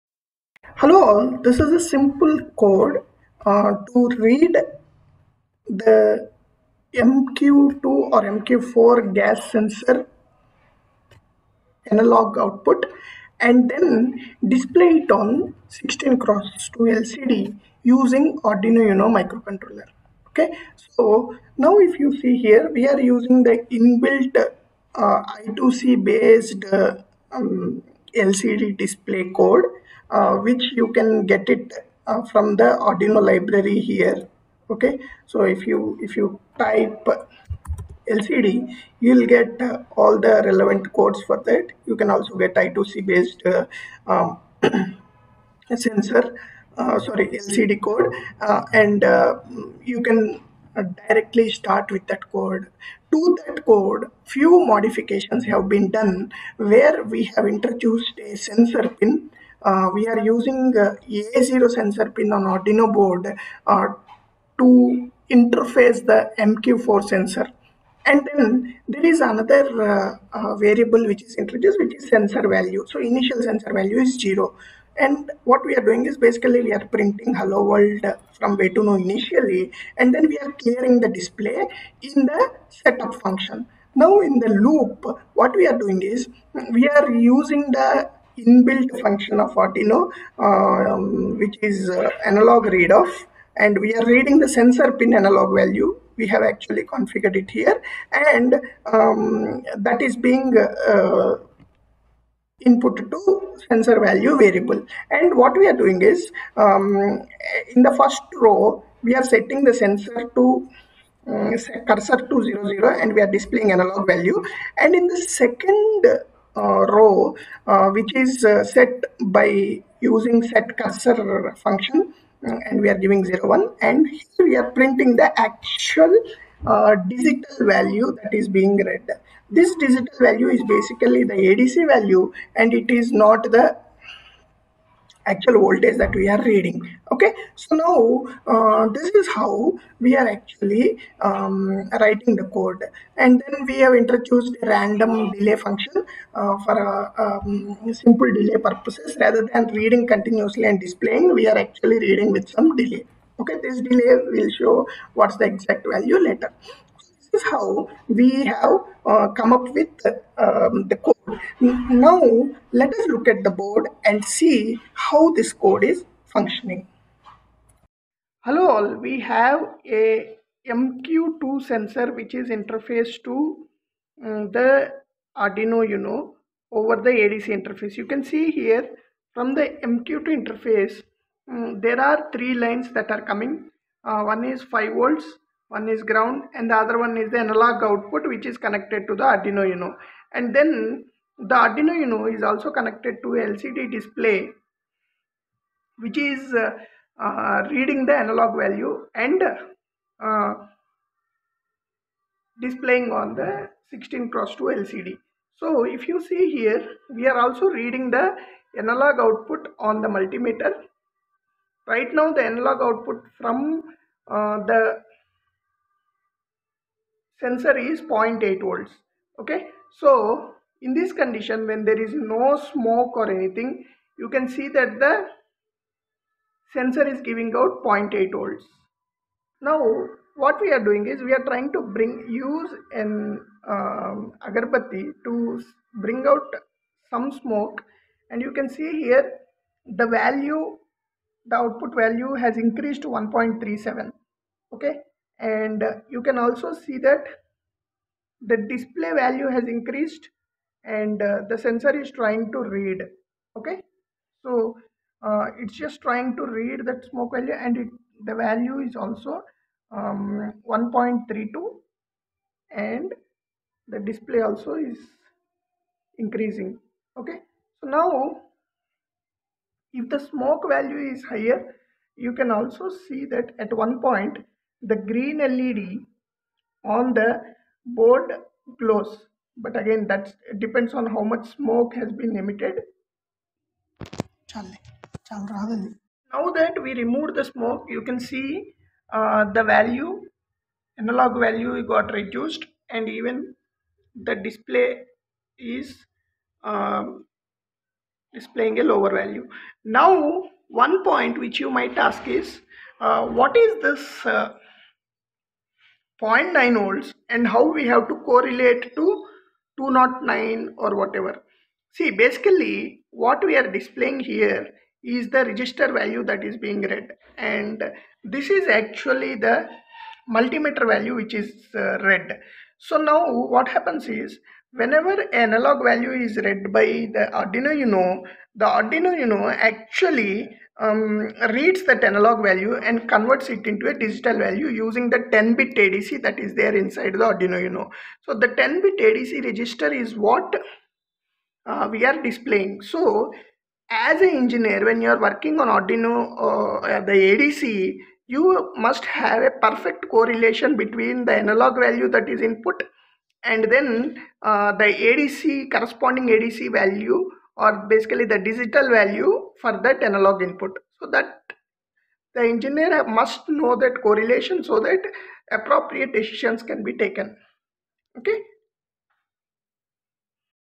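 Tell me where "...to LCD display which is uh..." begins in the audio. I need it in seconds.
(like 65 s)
193 s.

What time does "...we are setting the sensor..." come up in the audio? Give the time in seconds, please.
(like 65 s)
109 s.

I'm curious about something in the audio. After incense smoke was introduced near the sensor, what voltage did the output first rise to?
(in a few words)
1.37.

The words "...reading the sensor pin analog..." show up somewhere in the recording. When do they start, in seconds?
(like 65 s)
94 s.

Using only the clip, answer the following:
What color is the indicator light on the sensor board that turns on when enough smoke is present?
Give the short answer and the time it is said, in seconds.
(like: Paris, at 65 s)
green, at 274 s.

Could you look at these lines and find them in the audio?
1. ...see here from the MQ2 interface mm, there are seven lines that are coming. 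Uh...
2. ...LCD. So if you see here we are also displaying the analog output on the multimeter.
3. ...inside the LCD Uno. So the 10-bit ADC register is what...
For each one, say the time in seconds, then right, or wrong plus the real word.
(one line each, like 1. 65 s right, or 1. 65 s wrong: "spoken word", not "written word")
1. 178 s wrong: "three", not "seven"
2. 204 s wrong: "reading", not "displaying"
3. 336 s wrong: "Arduino", not "LCD".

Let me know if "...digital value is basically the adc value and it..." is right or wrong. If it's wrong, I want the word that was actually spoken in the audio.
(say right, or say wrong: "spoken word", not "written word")
right.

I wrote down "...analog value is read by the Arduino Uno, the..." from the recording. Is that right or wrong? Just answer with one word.
right.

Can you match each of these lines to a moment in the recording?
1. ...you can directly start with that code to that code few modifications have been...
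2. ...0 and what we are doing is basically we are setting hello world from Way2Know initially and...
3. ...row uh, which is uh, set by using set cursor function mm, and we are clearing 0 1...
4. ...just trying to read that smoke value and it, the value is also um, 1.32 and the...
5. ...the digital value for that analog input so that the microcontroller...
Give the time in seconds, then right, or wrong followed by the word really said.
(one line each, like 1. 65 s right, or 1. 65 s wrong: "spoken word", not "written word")
1. 49 s right
2. 74 s wrong: "printing", not "setting"
3. 116 s wrong: "giving", not "clearing"
4. 255 s right
5. 358 s wrong: "engineer", not "microcontroller".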